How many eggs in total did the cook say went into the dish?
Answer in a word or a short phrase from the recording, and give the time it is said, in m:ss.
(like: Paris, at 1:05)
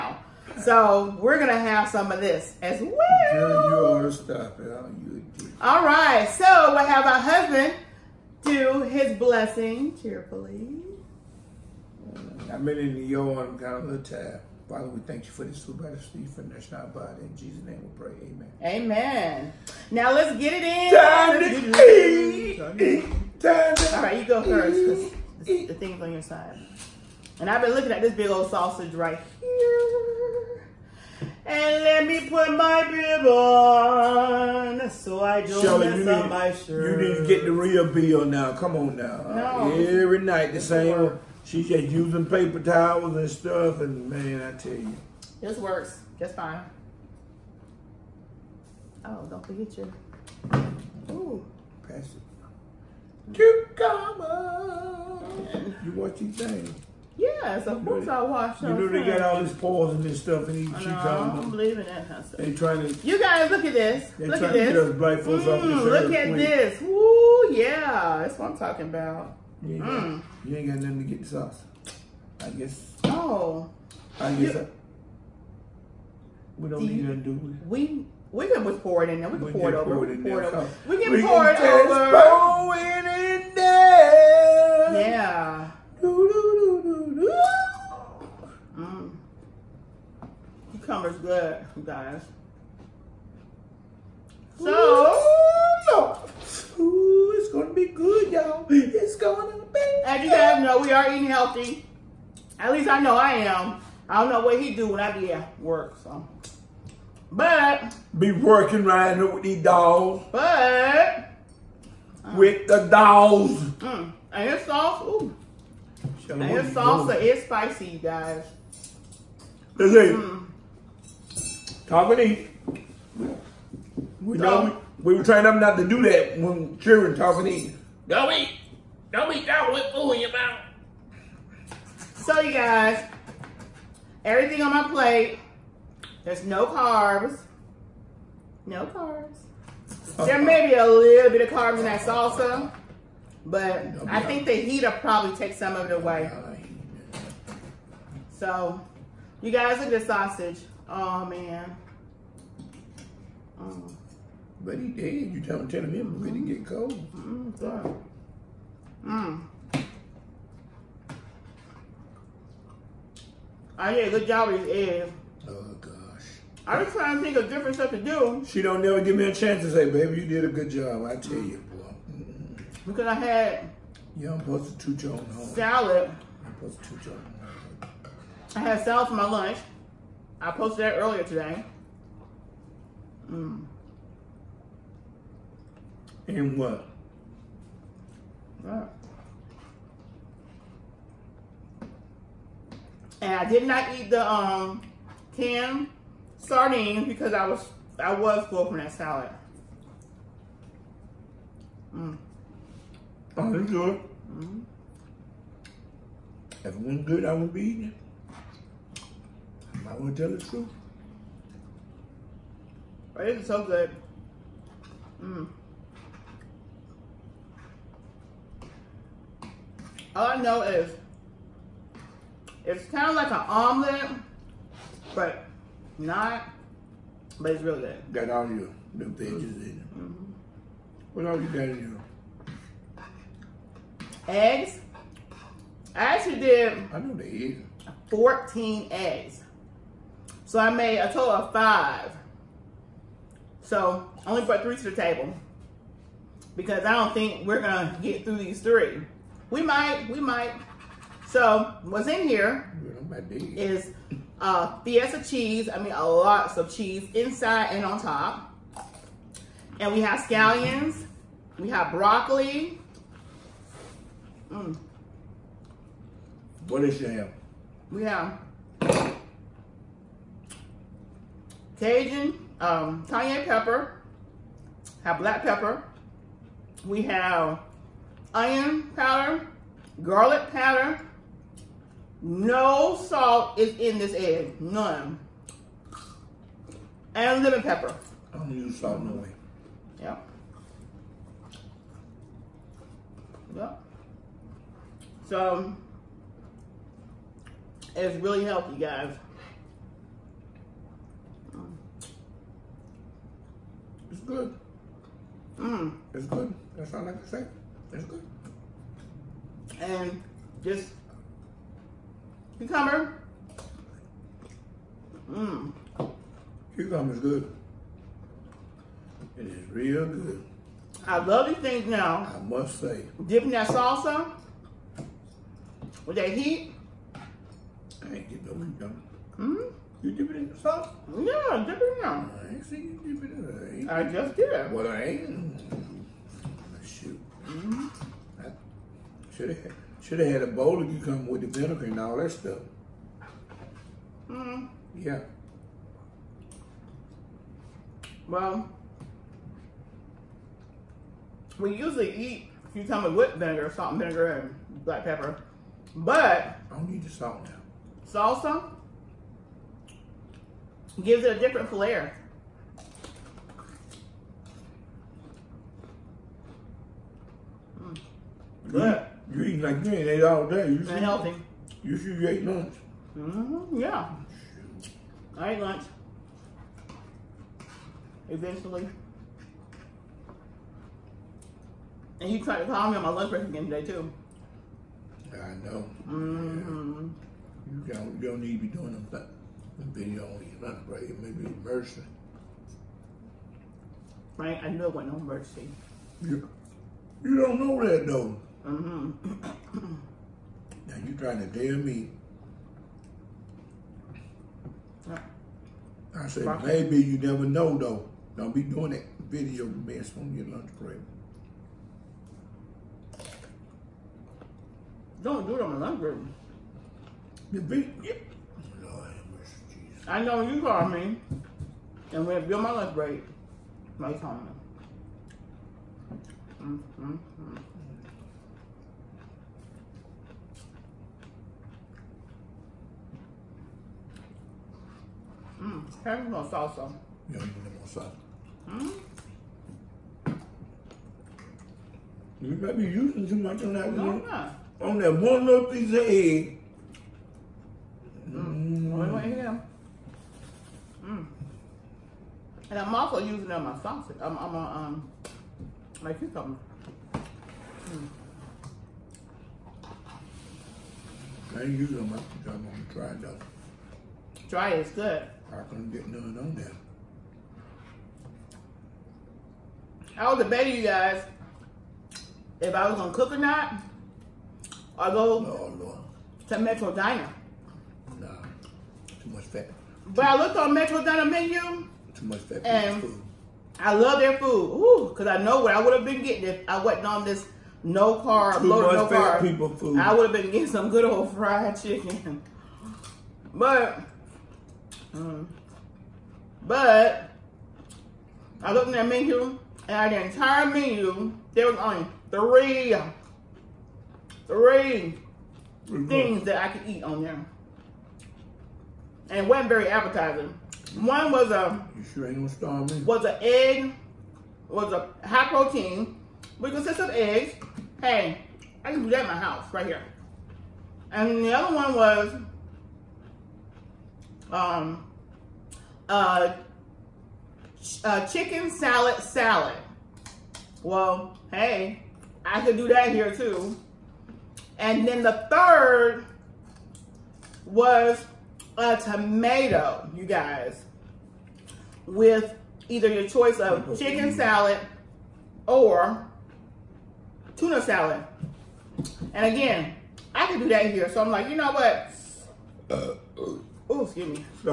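14, at 3:58.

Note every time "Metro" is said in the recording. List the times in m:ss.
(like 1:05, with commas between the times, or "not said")
7:56, 8:00.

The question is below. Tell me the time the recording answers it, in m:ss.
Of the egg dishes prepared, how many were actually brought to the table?
4:04.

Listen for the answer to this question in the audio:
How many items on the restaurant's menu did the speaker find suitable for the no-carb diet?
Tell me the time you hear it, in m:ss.
8:22.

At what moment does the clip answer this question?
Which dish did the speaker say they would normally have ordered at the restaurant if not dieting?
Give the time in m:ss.
8:11.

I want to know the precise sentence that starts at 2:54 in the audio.
You i not supposed to two John home.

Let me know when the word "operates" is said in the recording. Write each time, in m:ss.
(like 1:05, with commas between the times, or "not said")
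not said.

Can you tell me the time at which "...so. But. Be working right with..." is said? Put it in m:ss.
1:46.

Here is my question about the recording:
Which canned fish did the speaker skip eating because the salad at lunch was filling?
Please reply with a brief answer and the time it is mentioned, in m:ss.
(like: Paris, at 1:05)
Sardines, at 3:15.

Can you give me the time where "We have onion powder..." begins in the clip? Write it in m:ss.
4:36.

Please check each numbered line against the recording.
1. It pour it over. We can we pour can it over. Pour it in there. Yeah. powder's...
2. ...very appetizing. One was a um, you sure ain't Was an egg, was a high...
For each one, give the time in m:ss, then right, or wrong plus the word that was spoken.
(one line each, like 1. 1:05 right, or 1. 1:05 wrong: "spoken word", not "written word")
1. 1:20 wrong: "cucumber", not "powder"
2. 8:29 right.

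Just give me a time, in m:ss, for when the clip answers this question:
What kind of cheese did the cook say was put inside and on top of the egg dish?
4:14.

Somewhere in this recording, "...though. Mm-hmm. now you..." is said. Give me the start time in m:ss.
6:38.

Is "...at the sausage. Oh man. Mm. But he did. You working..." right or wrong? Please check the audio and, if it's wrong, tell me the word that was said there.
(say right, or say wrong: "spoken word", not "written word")
wrong: "telling", not "working".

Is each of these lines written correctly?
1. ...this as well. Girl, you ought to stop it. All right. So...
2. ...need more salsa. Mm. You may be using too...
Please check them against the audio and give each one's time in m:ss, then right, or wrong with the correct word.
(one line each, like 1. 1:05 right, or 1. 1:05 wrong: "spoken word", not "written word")
1. 0:02 right
2. 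7:17 right.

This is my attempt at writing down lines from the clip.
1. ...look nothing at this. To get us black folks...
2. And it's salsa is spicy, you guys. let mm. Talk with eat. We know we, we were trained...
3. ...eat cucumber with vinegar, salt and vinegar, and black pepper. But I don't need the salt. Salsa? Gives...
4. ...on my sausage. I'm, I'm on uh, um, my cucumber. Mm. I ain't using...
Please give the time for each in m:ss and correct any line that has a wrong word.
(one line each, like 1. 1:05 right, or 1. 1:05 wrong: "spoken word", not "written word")
1. 1:04 wrong: "trying", not "nothing"
2. 1:56 right
3. 5:52 right
4. 7:33 right.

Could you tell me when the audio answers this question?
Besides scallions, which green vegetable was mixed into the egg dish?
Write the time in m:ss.
4:21.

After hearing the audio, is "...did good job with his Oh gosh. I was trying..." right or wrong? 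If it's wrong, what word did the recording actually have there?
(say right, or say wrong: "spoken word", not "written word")
right.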